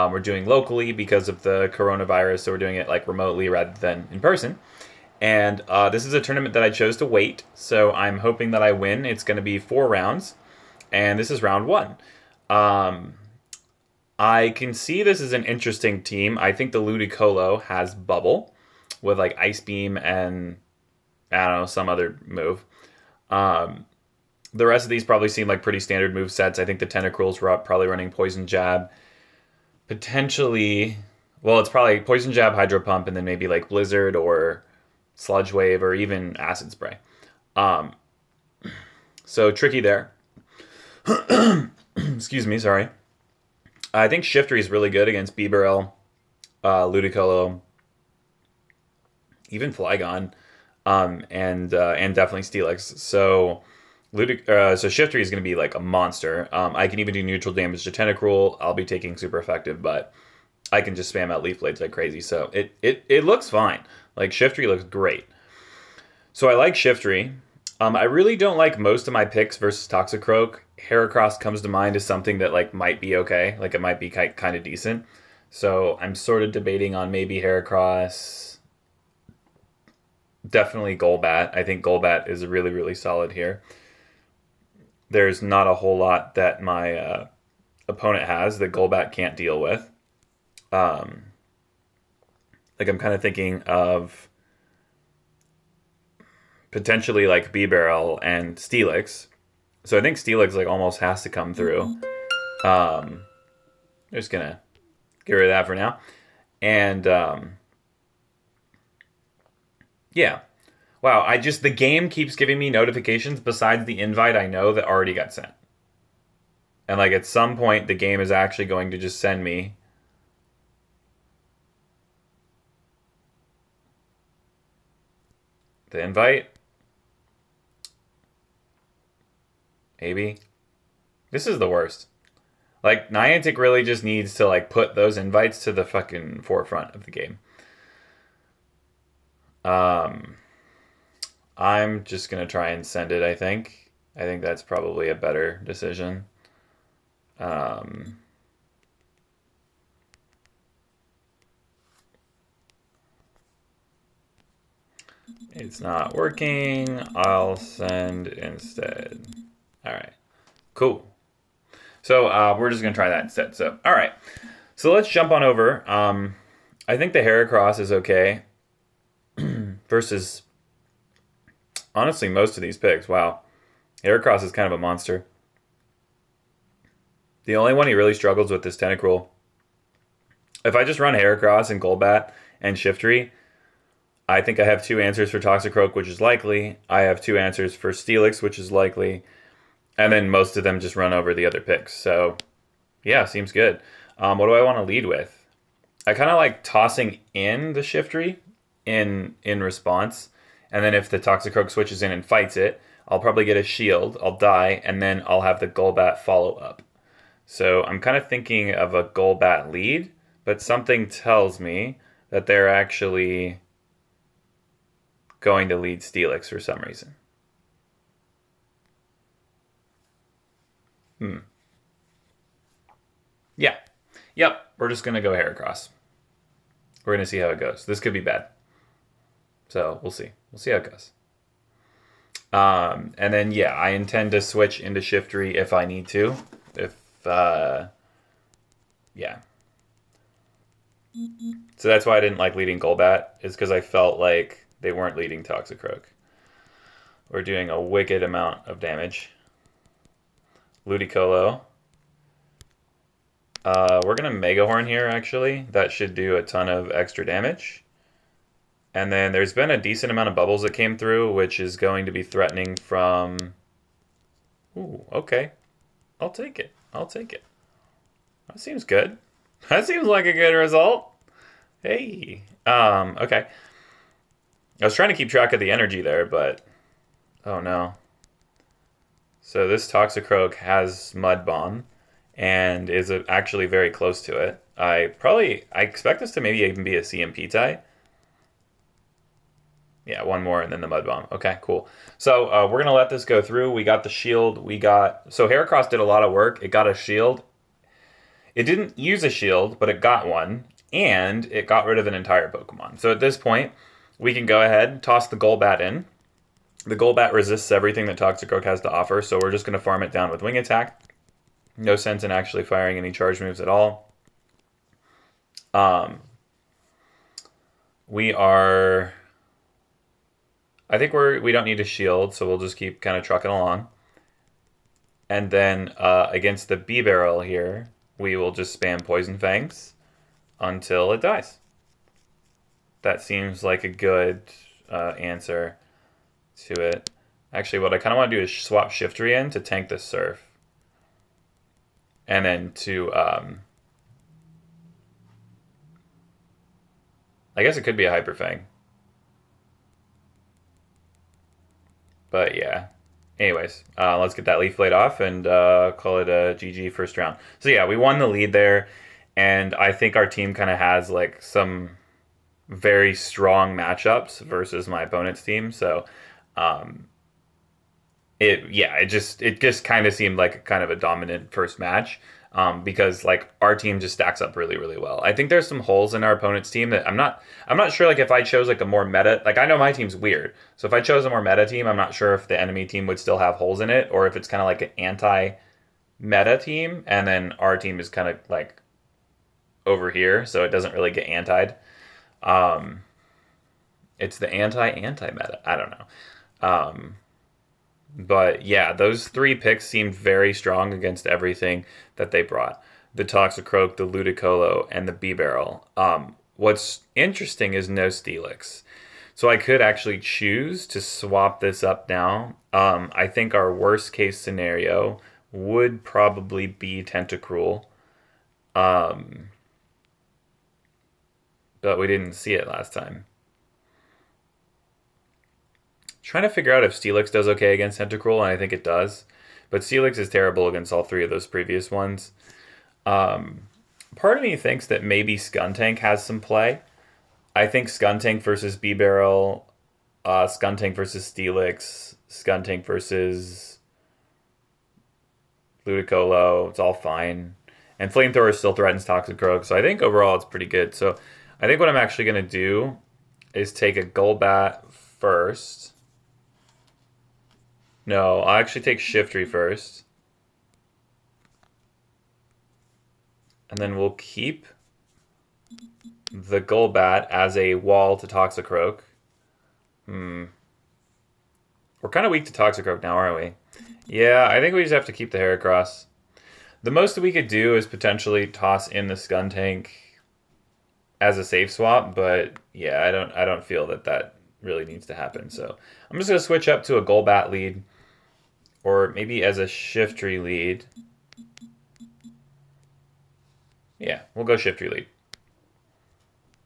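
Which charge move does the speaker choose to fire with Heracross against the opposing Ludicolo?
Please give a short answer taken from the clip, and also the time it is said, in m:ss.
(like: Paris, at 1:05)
Mega Horn, at 4:14.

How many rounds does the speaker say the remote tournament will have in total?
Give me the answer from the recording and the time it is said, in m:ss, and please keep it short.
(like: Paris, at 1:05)
4, at 0:09.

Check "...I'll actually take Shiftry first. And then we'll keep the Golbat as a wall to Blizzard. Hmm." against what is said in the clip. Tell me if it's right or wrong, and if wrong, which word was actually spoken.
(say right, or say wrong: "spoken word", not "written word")
wrong: "Toxicroak", not "Blizzard".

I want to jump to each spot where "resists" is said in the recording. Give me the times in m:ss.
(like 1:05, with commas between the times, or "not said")
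5:07.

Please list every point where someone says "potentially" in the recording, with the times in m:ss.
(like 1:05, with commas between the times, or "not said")
0:29, 1:36, 7:57.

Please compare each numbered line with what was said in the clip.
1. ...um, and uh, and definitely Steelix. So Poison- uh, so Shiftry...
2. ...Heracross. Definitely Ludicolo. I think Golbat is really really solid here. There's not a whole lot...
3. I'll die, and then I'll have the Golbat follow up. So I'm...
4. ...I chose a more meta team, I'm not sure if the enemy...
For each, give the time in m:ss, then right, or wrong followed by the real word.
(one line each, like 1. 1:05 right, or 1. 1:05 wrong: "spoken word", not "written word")
1. 0:50 wrong: "Ludic", not "Poison"
2. 1:17 wrong: "Golbat", not "Ludicolo"
3. 3:24 right
4. 6:20 right.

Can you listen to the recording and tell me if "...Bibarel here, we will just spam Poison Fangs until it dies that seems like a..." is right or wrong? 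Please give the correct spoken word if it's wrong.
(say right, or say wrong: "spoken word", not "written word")
right.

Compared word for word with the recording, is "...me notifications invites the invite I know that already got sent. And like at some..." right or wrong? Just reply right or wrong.
wrong.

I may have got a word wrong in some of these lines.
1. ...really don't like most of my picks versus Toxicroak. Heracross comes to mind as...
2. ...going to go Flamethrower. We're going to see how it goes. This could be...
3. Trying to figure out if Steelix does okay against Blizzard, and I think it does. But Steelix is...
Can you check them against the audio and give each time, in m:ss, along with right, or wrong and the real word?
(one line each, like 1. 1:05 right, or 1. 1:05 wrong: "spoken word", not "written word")
1. 1:08 right
2. 3:45 wrong: "Heracross", not "Flamethrower"
3. 7:06 wrong: "Tentacruel", not "Blizzard".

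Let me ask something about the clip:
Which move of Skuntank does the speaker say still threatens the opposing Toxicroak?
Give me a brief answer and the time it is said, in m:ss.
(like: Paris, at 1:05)
Flamethrower, at 7:28.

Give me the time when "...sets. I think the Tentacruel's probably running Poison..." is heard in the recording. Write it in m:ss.
0:26.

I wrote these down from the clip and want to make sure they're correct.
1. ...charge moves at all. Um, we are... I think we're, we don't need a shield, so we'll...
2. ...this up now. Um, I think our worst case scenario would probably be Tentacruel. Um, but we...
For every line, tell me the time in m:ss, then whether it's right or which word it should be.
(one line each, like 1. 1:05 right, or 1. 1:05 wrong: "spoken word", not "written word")
1. 5:13 right
2. 6:51 right.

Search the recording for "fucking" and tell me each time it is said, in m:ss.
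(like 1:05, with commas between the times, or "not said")
2:15.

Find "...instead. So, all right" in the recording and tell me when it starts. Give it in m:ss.
2:43.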